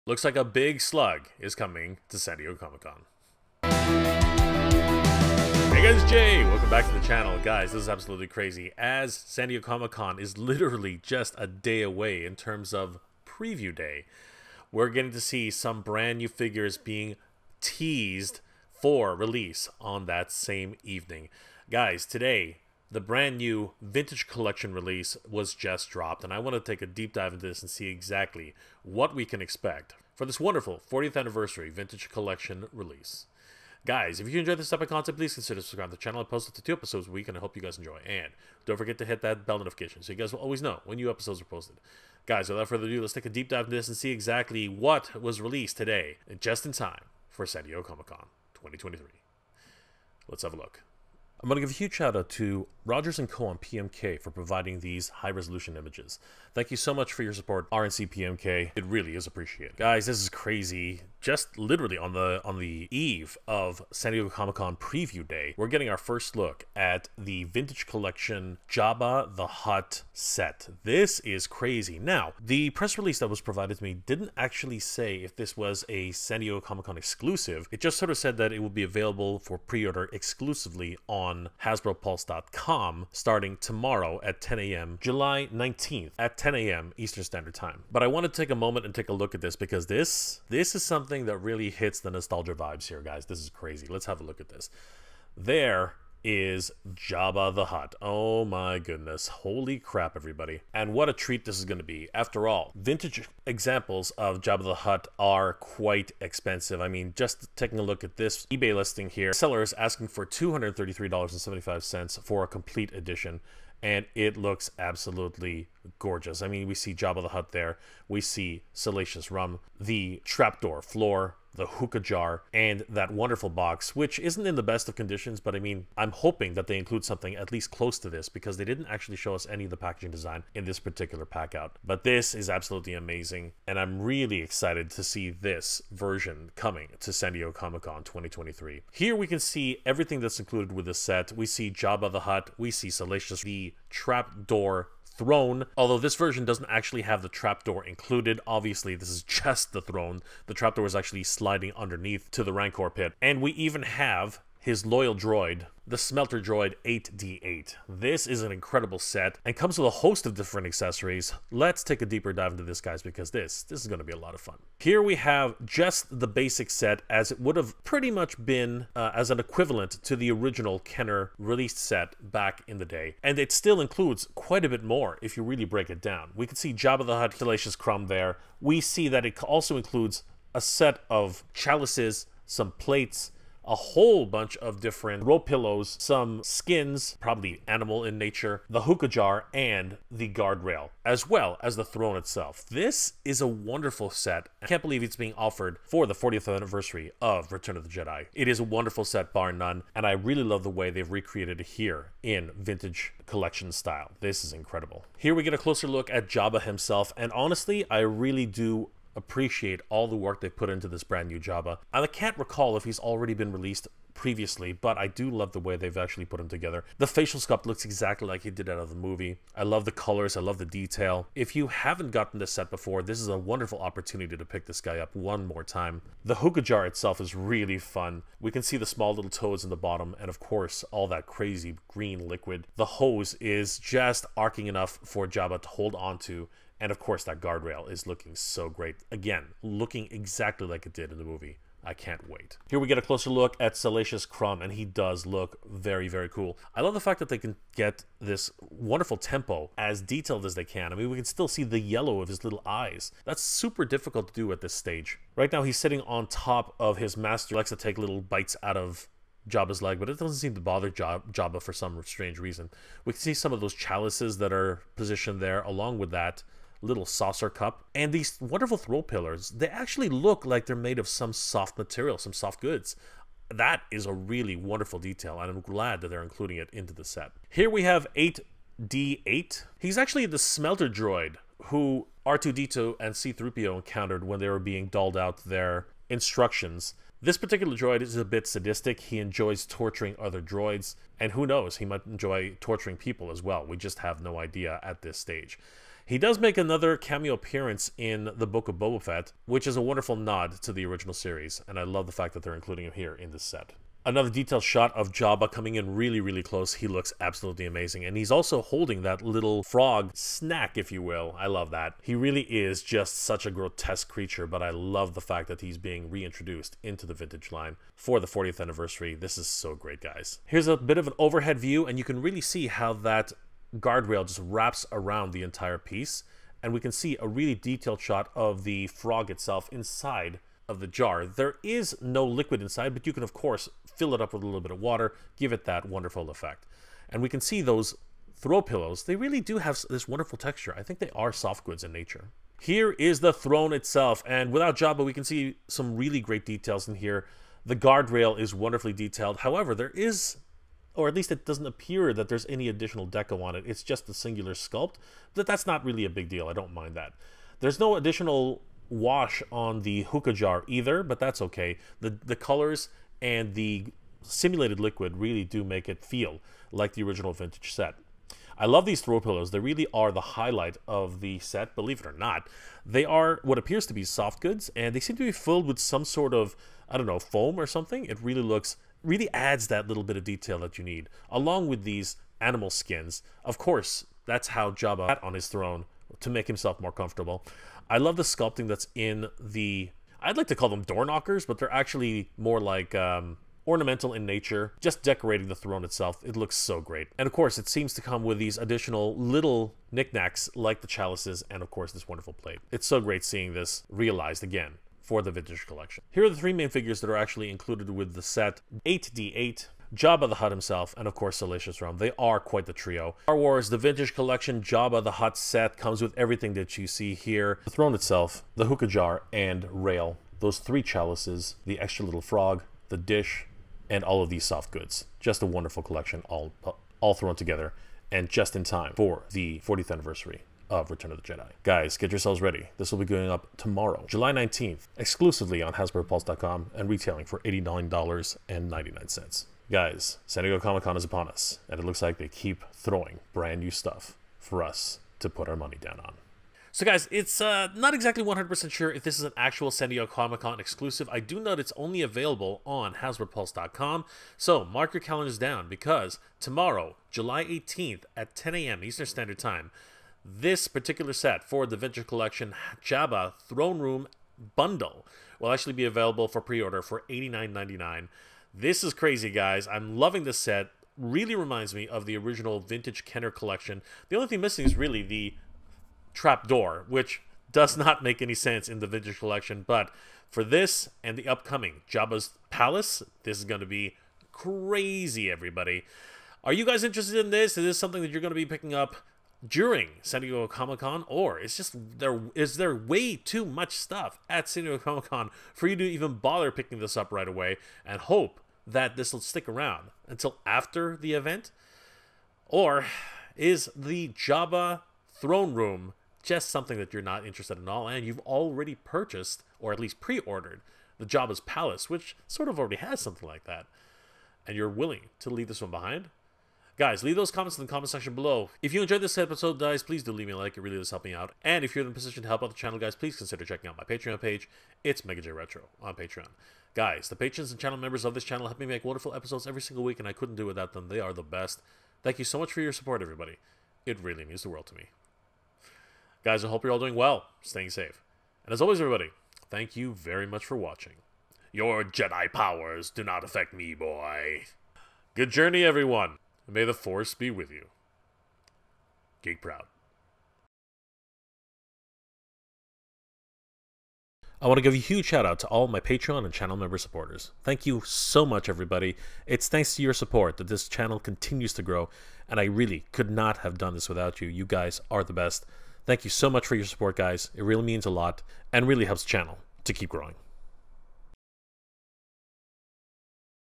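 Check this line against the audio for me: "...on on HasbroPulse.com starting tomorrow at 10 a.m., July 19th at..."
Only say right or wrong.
right.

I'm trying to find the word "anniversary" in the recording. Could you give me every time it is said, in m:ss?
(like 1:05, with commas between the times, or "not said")
0:31, 3:16, 5:18, 7:09.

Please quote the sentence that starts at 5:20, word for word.
Here's a bit of an overhead view, and you can really see how that guardrail just wraps around the entire piece.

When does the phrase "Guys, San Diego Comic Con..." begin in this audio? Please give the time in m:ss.
7:19.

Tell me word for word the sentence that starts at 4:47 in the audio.
This particular droid is a bit sadistic.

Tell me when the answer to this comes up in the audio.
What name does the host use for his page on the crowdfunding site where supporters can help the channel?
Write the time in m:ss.
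8:45.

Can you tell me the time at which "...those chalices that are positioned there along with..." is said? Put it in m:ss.
4:23.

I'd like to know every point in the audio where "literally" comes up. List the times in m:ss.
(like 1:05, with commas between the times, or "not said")
0:10, 1:01.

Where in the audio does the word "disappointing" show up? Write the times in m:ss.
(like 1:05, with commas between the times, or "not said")
not said.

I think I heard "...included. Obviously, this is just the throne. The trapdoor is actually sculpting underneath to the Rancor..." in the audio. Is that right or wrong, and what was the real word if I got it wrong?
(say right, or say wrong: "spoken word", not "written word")
wrong: "sliding", not "sculpting".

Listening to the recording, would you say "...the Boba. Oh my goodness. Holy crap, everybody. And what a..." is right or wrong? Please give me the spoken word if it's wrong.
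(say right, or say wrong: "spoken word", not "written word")
wrong: "Hutt", not "Boba".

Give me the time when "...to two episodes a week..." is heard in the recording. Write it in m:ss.
0:36.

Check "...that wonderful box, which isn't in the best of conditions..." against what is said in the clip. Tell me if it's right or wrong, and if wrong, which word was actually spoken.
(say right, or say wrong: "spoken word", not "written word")
right.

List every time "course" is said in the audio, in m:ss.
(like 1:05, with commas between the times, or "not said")
3:50, 3:56, 5:33, 6:23, 6:37, 6:41, 6:51.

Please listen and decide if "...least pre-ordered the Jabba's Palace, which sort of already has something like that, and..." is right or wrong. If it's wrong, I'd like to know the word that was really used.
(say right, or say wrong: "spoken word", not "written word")
right.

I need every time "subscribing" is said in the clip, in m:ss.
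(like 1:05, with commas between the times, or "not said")
0:35.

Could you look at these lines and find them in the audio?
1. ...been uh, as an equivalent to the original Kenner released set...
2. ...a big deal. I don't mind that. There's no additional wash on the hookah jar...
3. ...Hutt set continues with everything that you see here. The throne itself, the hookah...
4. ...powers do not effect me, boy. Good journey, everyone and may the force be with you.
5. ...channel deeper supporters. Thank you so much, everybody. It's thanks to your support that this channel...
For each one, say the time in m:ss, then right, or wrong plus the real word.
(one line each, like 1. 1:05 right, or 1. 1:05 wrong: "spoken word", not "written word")
1. 2:48 right
2. 5:56 right
3. 6:55 wrong: "comes", not "continues"
4. 9:02 wrong: "affect", not "effect"
5. 9:16 wrong: "member", not "deeper".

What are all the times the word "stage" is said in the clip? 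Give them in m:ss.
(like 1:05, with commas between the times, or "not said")
4:14, 4:55.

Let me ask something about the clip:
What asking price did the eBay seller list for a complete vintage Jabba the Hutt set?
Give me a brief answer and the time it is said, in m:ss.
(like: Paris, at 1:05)
$233.75, at 1:50.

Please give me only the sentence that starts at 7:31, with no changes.
I do note it's only available on HasbroPulse.com.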